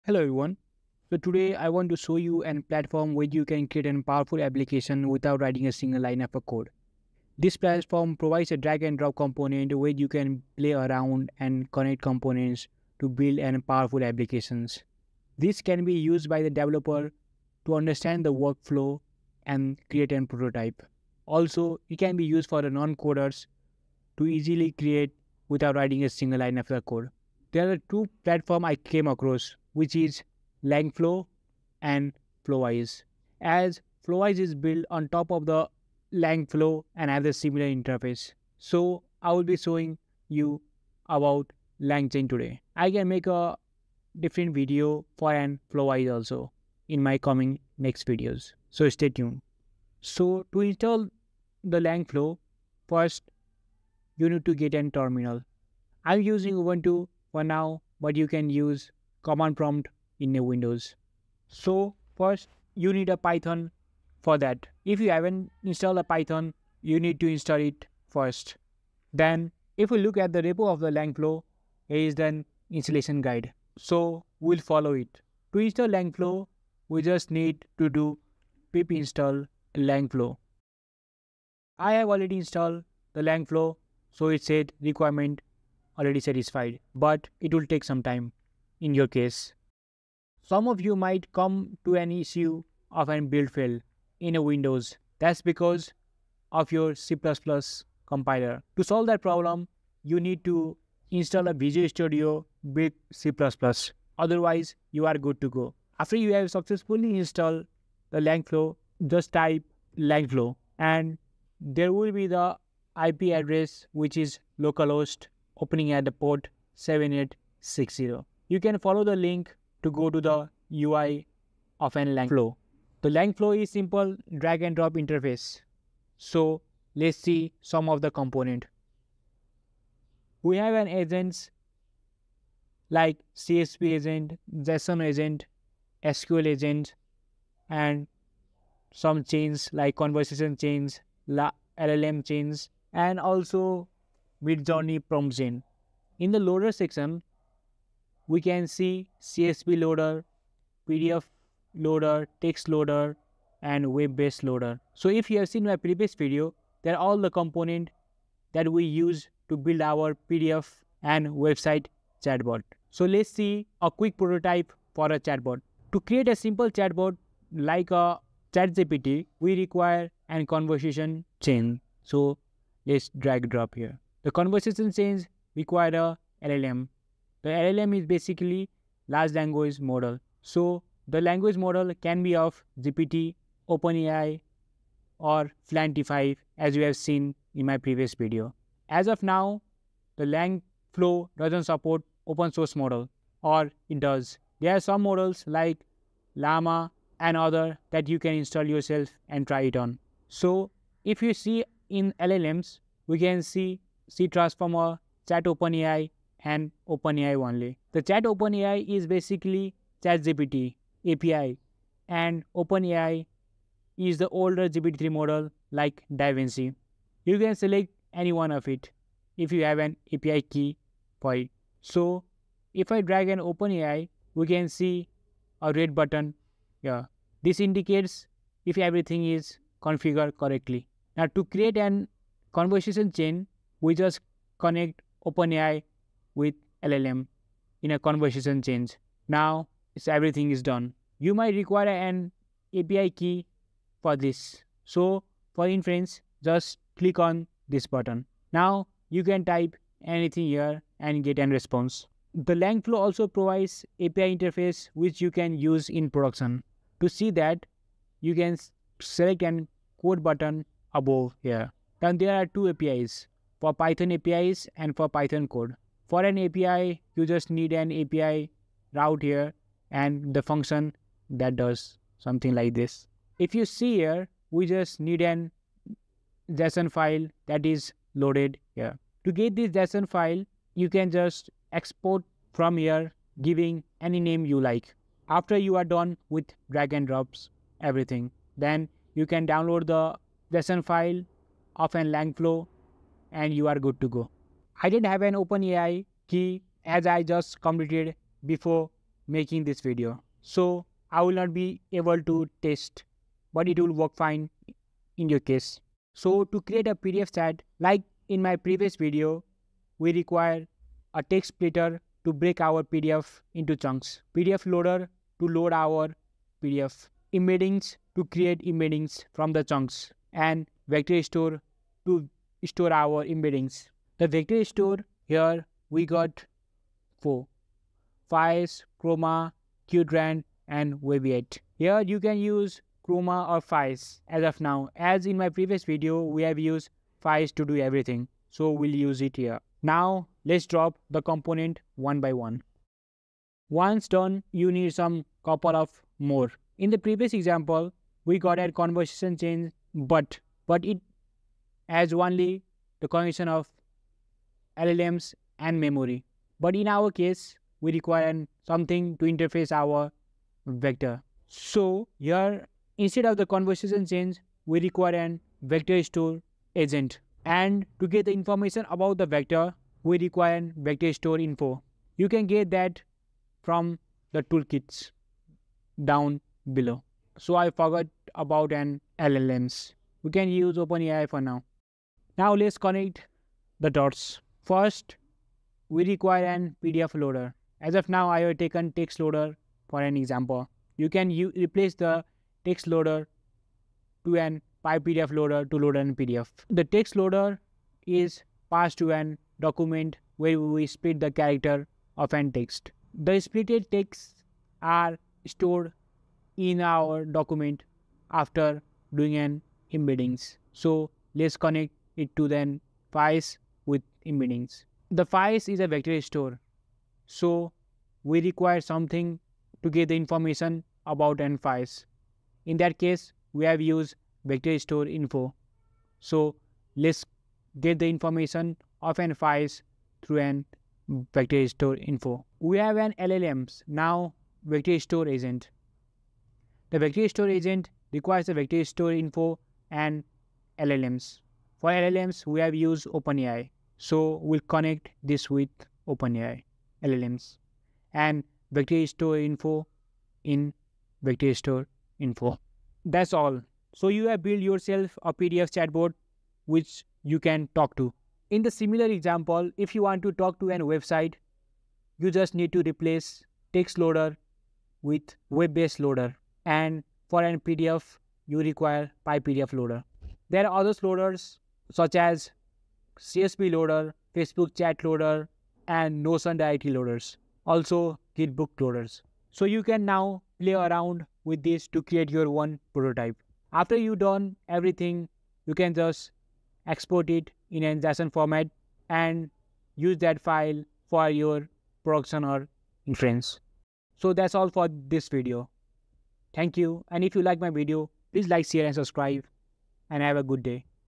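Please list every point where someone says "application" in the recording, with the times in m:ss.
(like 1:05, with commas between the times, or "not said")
0:04, 0:14.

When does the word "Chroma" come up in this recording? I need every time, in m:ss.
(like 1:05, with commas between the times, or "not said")
5:29, 5:33.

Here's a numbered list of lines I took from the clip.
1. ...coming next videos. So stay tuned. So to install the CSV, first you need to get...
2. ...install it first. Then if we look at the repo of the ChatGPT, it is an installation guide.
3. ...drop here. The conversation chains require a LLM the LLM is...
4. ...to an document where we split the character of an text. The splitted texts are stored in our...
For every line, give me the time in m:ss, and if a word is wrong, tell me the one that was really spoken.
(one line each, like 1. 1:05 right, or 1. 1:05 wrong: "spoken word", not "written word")
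1. 0:47 wrong: "LangFlow", not "CSV"
2. 1:07 wrong: "Langflow", not "ChatGPT"
3. 2:53 right
4. 6:38 right.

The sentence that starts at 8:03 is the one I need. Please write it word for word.
After you done everything, you can just export it in an JSON format and use that file for your production or inference.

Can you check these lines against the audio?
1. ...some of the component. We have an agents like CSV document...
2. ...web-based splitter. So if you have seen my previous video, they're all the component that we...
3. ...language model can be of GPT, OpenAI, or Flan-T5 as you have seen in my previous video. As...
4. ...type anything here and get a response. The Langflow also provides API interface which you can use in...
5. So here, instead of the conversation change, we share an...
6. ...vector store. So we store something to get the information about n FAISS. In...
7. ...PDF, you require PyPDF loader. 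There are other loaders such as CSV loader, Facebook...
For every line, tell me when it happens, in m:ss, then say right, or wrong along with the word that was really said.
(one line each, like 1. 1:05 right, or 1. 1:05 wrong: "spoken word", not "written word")
1. 2:07 wrong: "agent", not "document"
2. 2:33 wrong: "loader", not "splitter"
3. 3:01 right
4. 4:09 right
5. 6:01 wrong: "require", not "share"
6. 6:55 wrong: "require", not "store"
7. 7:47 right.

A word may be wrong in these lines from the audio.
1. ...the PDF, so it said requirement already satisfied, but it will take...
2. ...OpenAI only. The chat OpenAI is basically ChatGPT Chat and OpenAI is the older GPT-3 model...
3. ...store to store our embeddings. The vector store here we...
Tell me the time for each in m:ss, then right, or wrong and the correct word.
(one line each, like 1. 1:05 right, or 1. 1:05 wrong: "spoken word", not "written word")
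1. 1:23 wrong: "Langflow", not "PDF"
2. 3:26 wrong: "API", not "Chat"
3. 5:21 right.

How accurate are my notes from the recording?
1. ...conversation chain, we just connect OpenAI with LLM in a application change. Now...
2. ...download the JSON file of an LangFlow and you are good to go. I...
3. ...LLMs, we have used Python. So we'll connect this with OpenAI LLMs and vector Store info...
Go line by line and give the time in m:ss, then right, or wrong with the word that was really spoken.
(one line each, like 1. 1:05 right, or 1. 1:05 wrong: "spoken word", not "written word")
1. 3:52 wrong: "conversation", not "application"
2. 4:49 right
3. 7:21 wrong: "OpenAI", not "Python".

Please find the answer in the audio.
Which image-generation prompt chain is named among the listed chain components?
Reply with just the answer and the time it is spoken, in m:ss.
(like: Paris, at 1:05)
Midjourney prompt chain, at 2:24.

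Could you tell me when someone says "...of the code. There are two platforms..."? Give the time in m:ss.
0:26.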